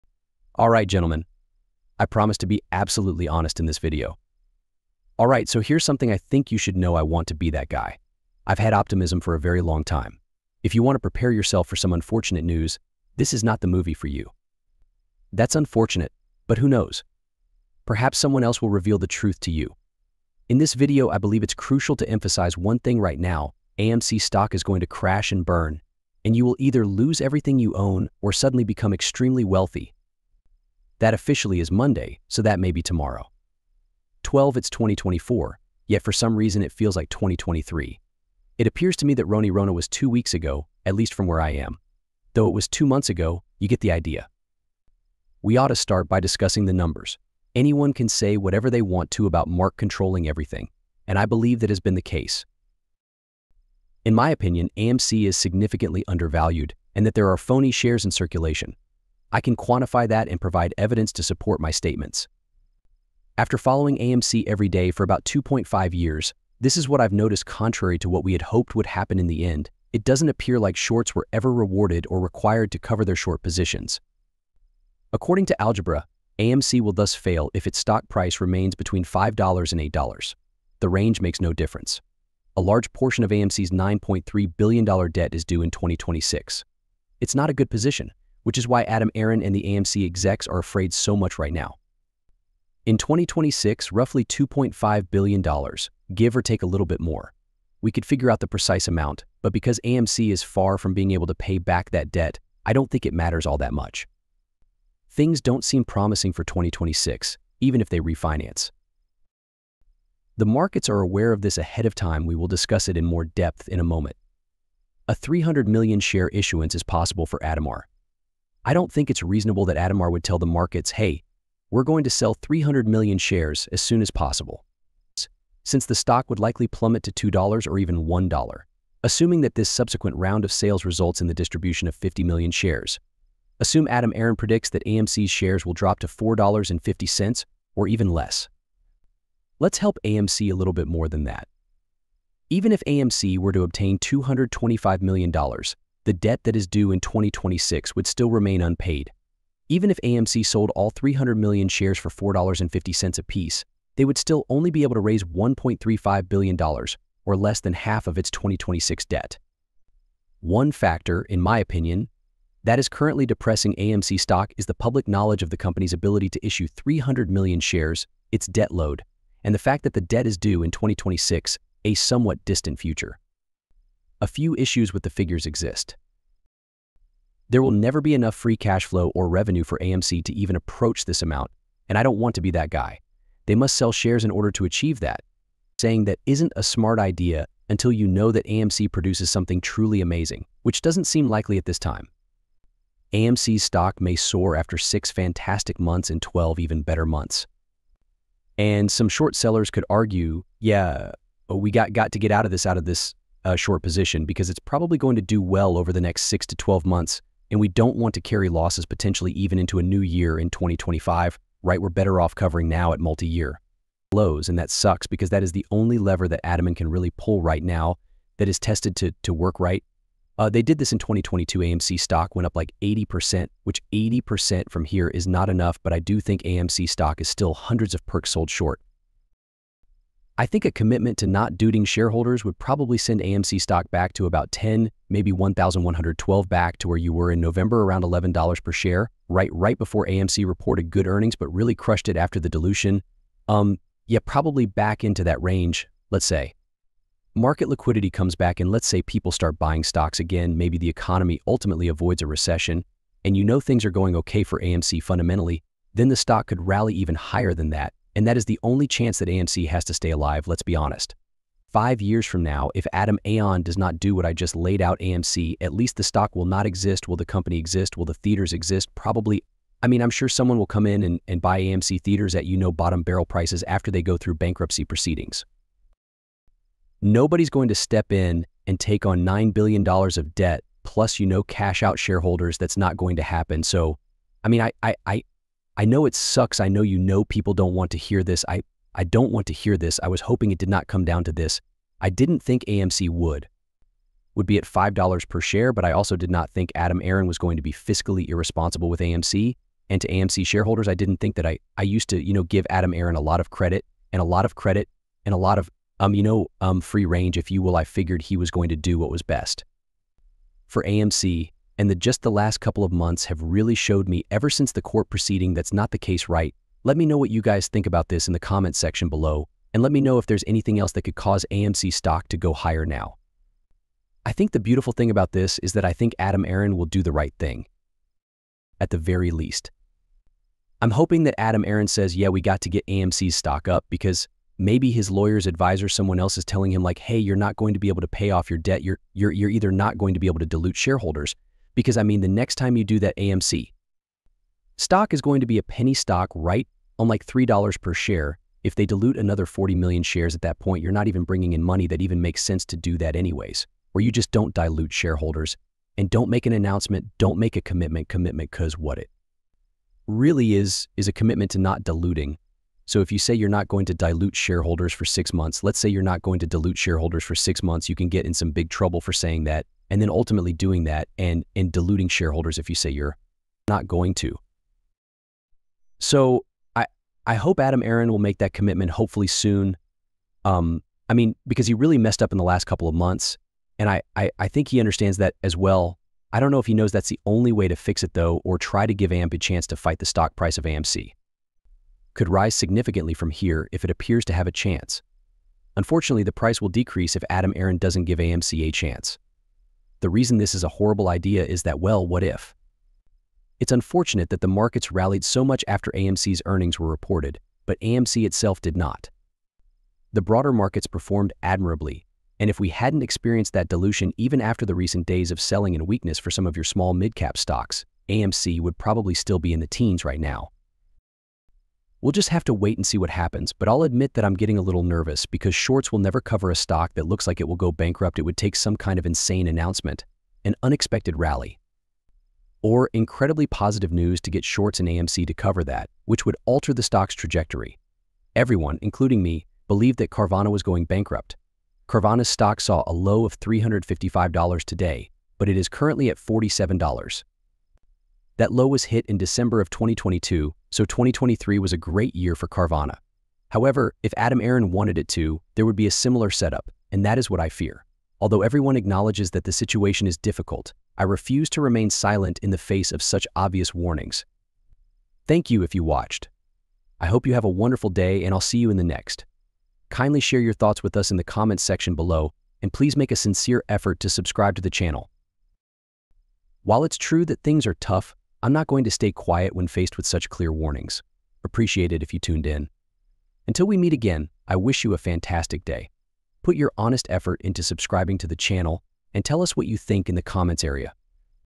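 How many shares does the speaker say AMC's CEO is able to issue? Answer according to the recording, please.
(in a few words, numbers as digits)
300 million.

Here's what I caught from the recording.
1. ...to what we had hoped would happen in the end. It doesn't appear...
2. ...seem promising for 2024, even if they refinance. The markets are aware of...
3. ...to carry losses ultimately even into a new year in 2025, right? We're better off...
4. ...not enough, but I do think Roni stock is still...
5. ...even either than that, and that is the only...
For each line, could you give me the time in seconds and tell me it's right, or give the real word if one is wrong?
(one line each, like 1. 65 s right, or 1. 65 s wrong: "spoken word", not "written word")
1. 67 s right
2. 105 s wrong: "2026", not "2024"
3. 208 s wrong: "potentially", not "ultimately"
4. 225 s wrong: "AMC", not "Roni"
5. 256 s wrong: "higher", not "either".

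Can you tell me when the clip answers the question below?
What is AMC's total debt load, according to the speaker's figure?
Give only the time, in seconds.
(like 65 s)
83 s.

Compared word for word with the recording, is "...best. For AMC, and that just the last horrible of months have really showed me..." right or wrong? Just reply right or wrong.
wrong.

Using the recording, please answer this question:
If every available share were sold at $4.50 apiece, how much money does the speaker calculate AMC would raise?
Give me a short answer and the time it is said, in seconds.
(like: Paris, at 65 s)
$1.35 billion, at 155 s.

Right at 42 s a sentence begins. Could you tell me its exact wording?
Though it was two months ago, you get the idea.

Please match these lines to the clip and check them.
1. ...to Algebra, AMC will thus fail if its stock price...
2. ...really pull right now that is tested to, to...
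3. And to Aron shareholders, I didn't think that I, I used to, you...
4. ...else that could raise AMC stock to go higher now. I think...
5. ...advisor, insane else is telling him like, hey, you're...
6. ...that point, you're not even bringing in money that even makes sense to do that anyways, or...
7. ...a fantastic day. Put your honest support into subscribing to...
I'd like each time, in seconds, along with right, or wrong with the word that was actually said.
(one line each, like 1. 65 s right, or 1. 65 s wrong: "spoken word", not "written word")
1. 75 s right
2. 216 s right
3. 299 s wrong: "AMC", not "Aron"
4. 320 s wrong: "cause", not "raise"
5. 335 s wrong: "someone", not "insane"
6. 350 s right
7. 484 s wrong: "effort", not "support".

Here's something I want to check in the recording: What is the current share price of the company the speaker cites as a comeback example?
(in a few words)
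$47.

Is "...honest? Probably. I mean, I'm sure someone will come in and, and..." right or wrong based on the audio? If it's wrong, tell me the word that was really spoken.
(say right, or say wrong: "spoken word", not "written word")
wrong: "exist", not "honest".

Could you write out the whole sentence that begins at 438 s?
Everyone, including me, believed that Carvana was going bankrupt.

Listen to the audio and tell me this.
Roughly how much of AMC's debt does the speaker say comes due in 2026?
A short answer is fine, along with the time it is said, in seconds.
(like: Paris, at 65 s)
$2.5 billion, at 94 s.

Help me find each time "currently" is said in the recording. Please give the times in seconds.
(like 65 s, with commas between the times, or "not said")
162 s, 445 s.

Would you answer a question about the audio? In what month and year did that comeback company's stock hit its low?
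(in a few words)
December 2022.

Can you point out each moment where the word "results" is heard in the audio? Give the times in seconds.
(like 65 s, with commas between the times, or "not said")
130 s.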